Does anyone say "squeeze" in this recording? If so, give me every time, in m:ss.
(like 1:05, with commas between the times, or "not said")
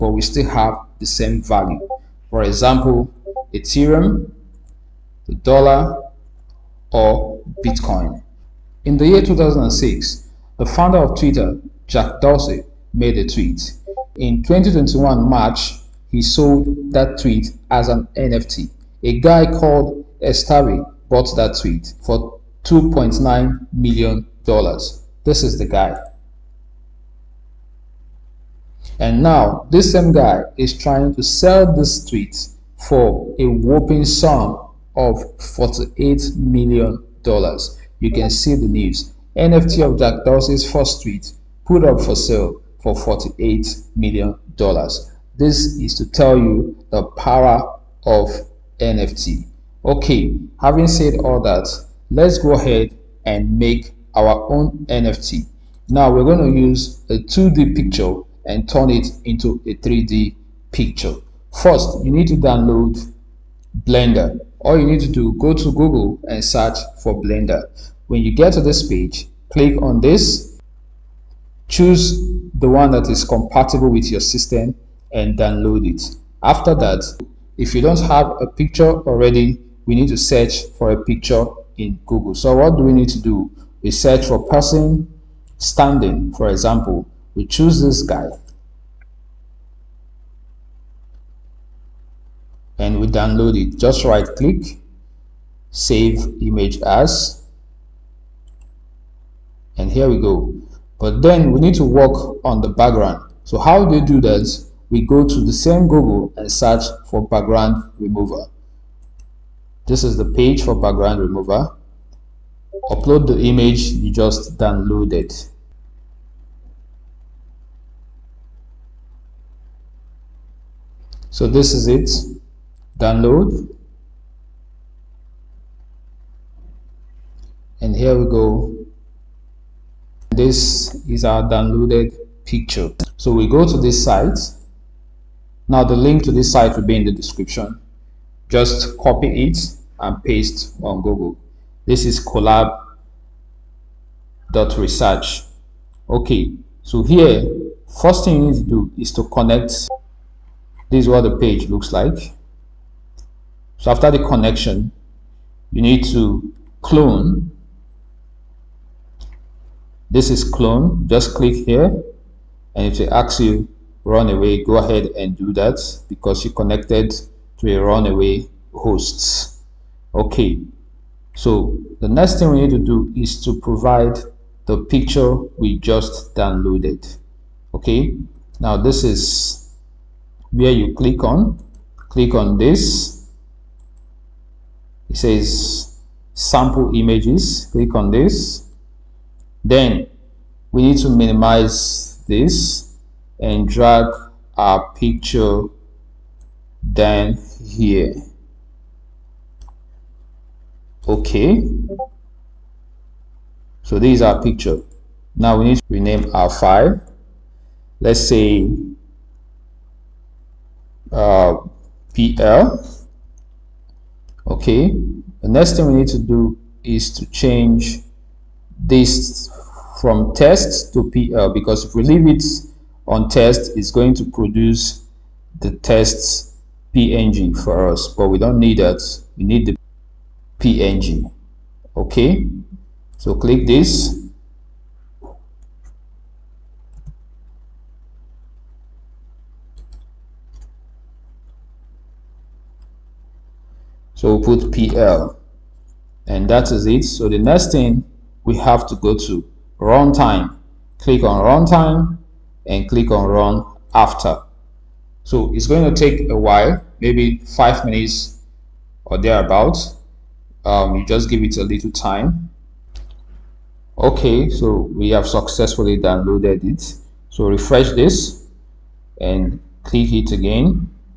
not said.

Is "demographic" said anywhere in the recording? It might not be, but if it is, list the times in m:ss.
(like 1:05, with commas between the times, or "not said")
not said.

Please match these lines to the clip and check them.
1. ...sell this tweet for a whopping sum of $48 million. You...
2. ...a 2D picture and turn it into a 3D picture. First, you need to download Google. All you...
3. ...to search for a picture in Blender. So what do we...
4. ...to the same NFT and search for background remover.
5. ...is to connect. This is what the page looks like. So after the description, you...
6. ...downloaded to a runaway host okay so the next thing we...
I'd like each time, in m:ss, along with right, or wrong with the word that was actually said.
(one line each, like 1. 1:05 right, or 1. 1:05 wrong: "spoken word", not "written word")
1. 0:31 right
2. 0:57 wrong: "Blender", not "Google"
3. 1:20 wrong: "Google", not "Blender"
4. 1:45 wrong: "Google", not "NFT"
5. 2:28 wrong: "connection", not "description"
6. 2:46 wrong: "connected", not "downloaded".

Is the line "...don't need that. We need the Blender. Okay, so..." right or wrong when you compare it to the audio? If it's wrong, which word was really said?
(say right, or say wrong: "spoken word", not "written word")
wrong: "PNG", not "Blender".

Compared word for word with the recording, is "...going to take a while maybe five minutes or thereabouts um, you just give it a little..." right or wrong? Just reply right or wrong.
right.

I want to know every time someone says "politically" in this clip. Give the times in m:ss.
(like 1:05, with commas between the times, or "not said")
not said.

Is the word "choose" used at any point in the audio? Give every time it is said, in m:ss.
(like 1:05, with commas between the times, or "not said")
1:11, 1:27.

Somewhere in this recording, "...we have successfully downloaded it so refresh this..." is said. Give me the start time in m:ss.
4:24.